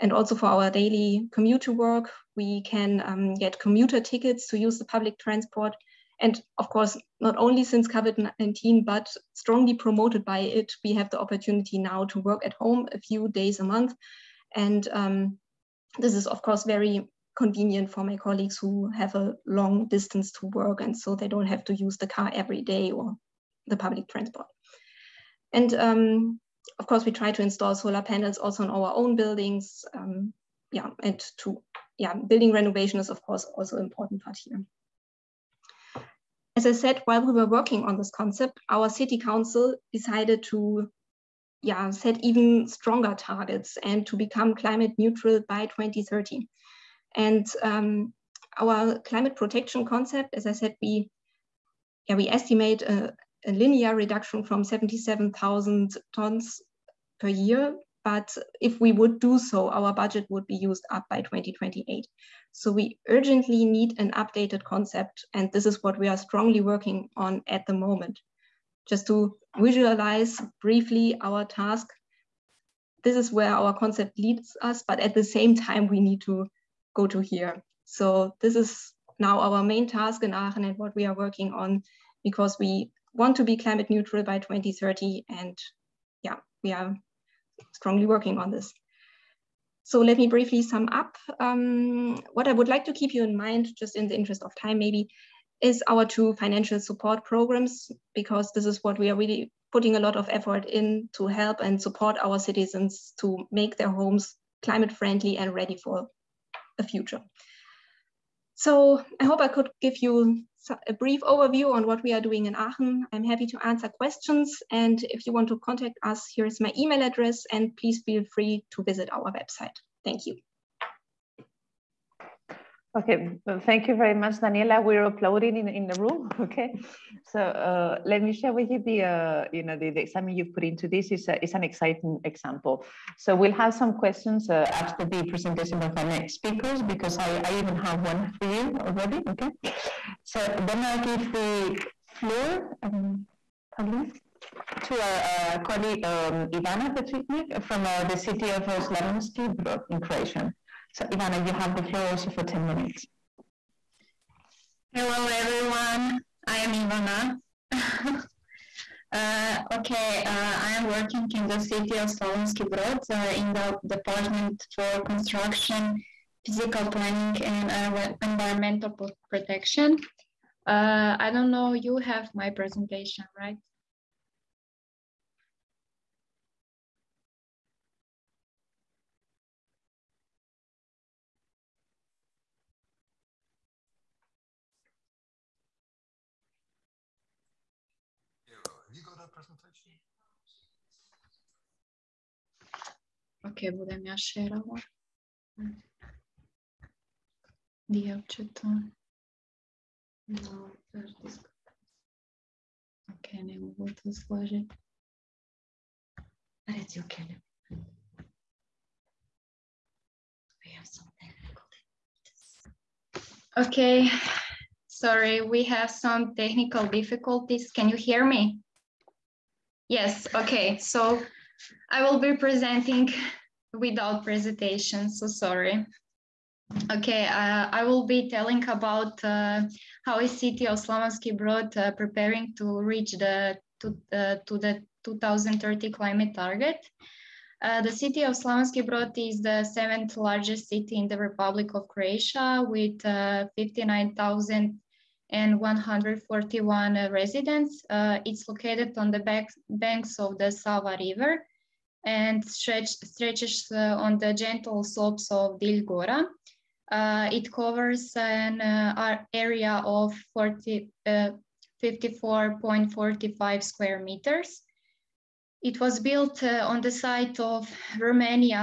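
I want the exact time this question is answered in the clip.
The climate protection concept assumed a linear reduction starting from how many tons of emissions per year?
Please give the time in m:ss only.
0:54.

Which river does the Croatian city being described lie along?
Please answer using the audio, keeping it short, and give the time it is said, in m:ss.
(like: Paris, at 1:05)
Sava, at 4:10.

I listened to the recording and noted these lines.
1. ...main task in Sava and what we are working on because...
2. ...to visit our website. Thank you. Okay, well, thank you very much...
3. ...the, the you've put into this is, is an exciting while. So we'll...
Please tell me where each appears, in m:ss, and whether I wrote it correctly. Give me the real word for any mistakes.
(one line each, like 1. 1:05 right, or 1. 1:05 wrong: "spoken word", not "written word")
1. 1:19 wrong: "Aachen", not "Sava"
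2. 1:58 right
3. 2:09 wrong: "example", not "while".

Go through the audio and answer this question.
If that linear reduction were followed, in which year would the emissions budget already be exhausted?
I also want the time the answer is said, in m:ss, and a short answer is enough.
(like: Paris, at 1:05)
2028, at 1:01.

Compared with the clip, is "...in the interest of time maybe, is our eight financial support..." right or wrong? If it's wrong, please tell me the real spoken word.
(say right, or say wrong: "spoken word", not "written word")
wrong: "two", not "eight".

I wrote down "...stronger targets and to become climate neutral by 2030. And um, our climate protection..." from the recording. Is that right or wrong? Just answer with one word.
right.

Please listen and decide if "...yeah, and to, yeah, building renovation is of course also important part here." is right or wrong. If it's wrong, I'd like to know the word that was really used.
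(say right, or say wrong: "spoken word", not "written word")
right.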